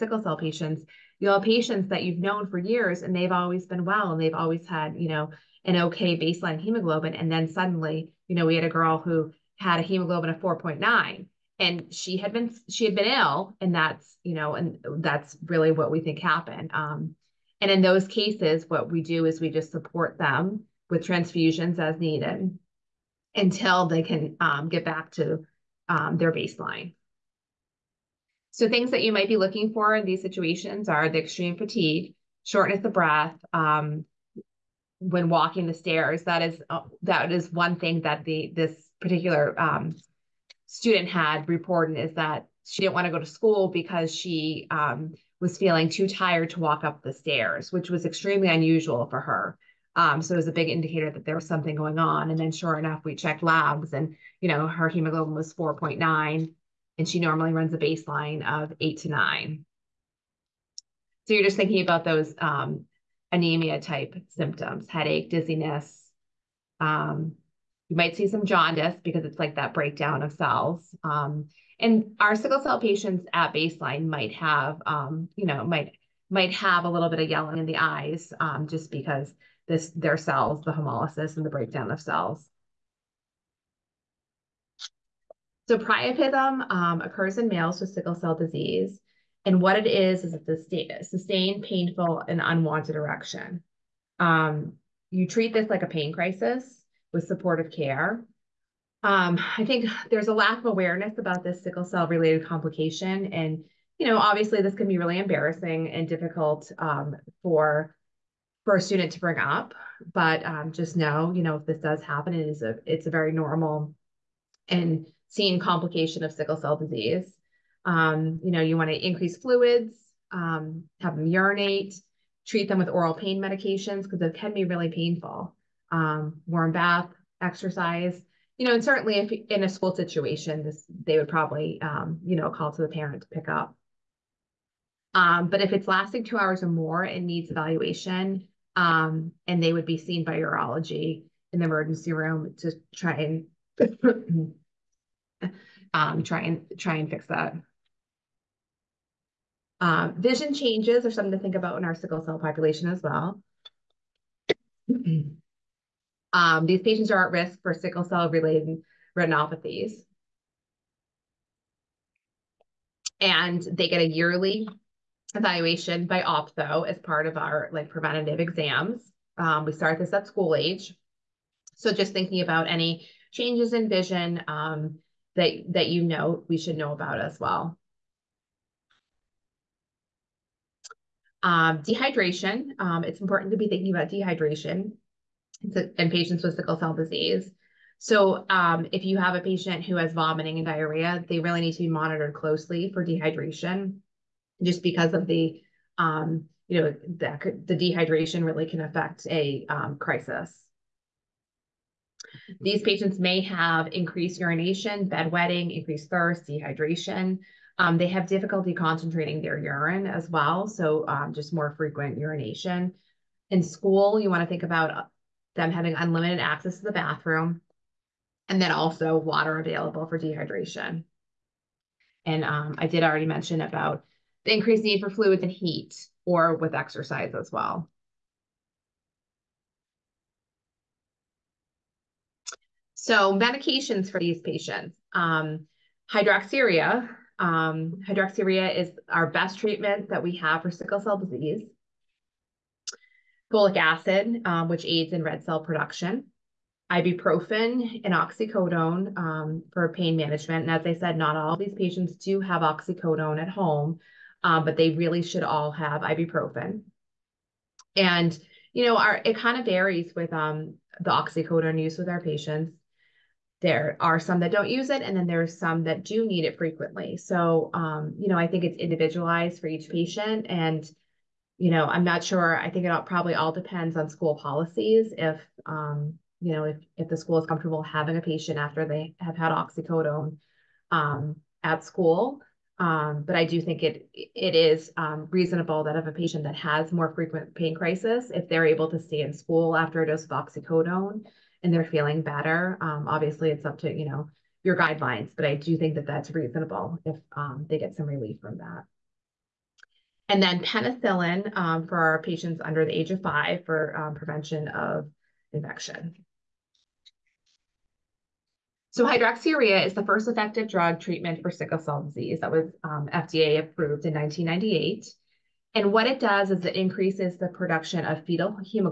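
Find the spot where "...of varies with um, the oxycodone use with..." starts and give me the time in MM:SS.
04:19.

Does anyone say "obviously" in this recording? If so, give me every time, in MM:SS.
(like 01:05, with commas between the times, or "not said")
01:44, 04:53.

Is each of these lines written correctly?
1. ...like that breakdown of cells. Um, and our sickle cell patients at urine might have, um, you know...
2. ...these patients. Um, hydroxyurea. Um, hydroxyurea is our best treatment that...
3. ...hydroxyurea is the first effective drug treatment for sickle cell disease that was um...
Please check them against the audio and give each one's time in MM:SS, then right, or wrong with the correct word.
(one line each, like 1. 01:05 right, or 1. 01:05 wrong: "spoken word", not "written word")
1. 01:09 wrong: "baseline", not "urine"
2. 03:54 right
3. 05:09 right.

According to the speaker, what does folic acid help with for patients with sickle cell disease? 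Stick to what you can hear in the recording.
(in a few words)
Red cell production.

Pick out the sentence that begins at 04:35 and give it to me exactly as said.
If, um, you know, if, if the school is comfortable having a patient after they have had oxycodone um, at school.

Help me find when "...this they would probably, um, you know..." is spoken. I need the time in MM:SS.
02:10.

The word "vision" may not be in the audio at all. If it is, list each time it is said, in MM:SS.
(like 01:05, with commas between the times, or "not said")
02:30, 02:53.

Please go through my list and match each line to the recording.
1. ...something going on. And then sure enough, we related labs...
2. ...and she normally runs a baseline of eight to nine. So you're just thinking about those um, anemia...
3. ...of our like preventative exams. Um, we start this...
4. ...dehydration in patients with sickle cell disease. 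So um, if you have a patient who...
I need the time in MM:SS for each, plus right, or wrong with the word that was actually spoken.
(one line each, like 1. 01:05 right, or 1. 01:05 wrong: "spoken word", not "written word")
1. 00:51 wrong: "checked", not "related"
2. 00:56 right
3. 02:47 right
4. 03:04 right.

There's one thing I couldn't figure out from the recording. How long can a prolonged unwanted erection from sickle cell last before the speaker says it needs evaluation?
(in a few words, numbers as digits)
2 hours.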